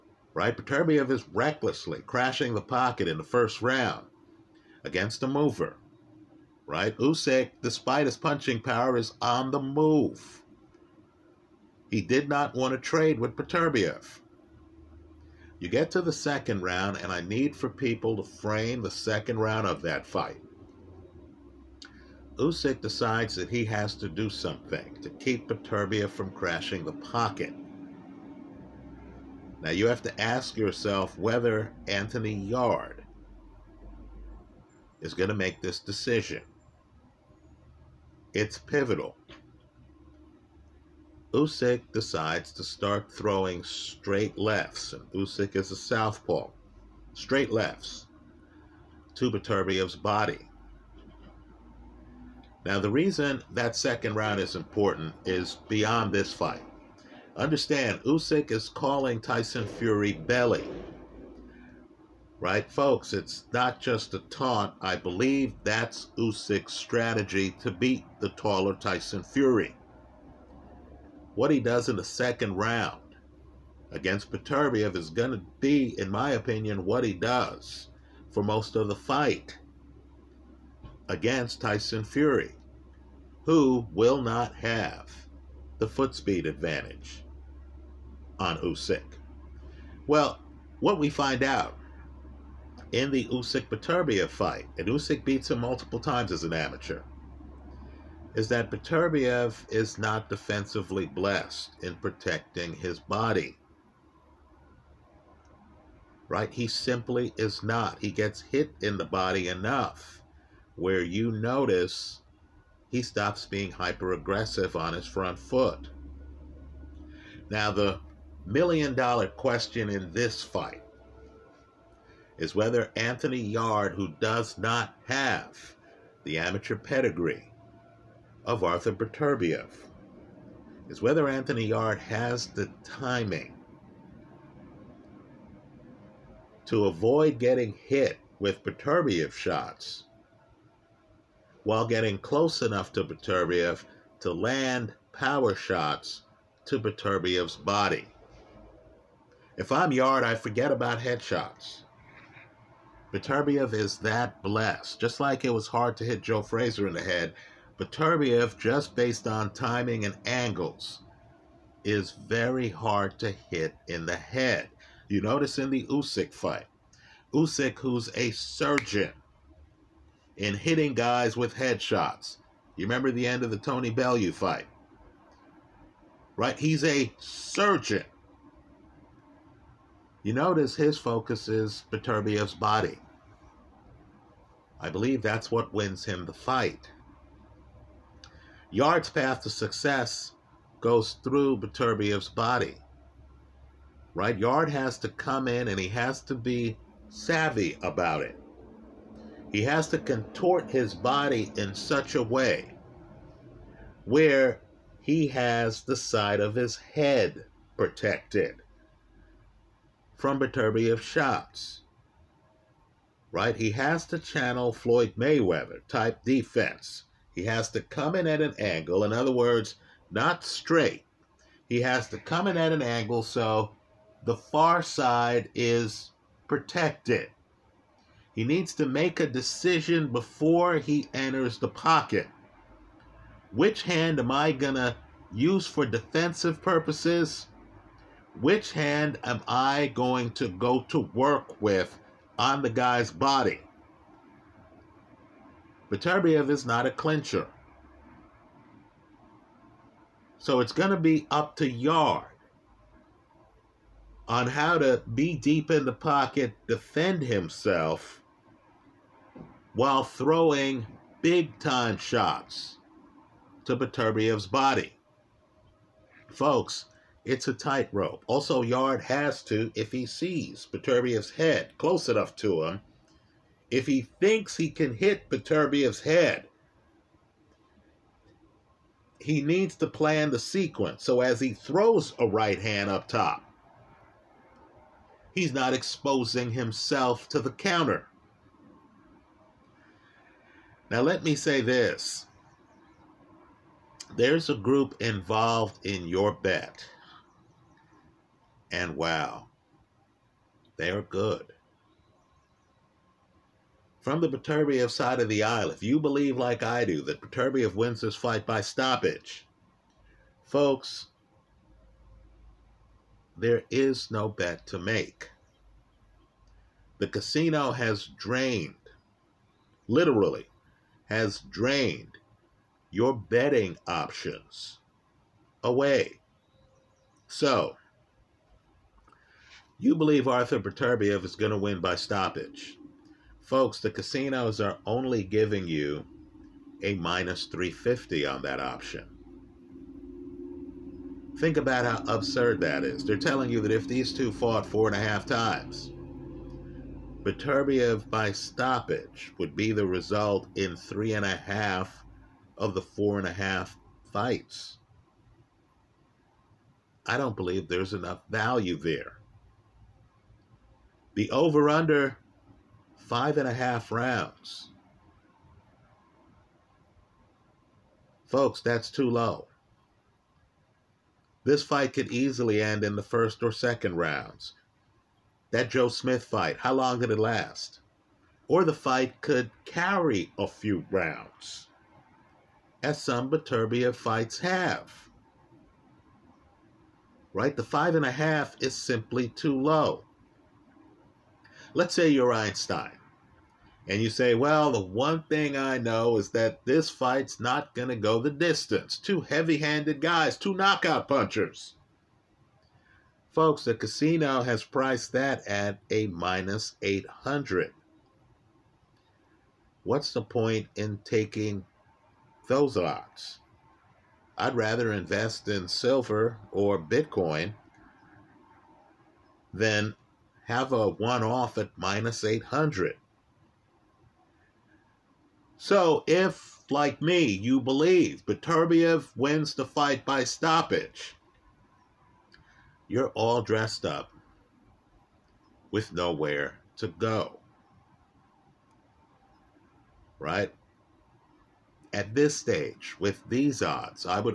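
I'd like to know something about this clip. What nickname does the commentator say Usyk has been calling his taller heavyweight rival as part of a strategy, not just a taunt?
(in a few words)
Belly.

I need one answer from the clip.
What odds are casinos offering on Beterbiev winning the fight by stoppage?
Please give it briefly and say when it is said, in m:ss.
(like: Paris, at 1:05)
-350, at 5:36.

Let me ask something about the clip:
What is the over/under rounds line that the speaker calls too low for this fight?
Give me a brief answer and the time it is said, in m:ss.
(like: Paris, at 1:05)
5.5 rounds, at 6:03.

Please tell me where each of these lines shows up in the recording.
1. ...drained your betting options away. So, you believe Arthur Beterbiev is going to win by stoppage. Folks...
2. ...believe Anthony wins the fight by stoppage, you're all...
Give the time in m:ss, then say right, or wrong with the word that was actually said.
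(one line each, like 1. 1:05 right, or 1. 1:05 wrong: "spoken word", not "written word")
1. 5:21 right
2. 7:07 wrong: "Beterbiev", not "Anthony".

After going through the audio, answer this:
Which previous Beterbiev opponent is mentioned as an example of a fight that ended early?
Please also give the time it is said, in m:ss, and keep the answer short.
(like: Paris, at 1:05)
Joe Smith, at 6:15.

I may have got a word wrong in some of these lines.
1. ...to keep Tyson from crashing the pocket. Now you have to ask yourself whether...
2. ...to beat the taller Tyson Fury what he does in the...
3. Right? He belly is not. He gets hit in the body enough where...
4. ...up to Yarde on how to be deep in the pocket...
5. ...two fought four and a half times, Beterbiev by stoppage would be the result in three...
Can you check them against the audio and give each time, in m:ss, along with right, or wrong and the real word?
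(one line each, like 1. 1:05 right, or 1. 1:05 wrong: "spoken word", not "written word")
1. 0:25 wrong: "Beterbiev", not "Tyson"
2. 1:07 right
3. 1:46 wrong: "simply", not "belly"
4. 4:11 right
5. 5:44 right.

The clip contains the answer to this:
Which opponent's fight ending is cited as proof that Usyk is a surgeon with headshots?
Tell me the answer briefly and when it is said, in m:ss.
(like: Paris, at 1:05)
Tony Bellew, at 2:53.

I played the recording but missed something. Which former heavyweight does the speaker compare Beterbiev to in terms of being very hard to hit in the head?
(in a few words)
Joe Frazier.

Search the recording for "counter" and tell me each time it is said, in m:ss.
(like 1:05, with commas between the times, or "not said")
4:47.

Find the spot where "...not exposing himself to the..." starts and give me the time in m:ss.
4:45.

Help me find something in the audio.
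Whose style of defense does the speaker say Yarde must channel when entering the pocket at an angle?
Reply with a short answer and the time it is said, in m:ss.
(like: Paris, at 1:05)
Floyd Mayweather, at 3:34.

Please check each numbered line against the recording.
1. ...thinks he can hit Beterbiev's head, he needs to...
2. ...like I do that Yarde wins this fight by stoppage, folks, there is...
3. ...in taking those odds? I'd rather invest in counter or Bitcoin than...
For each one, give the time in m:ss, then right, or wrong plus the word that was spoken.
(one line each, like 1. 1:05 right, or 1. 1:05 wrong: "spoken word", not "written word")
1. 4:34 right
2. 5:06 wrong: "Beterbiev", not "Yarde"
3. 6:50 wrong: "silver", not "counter".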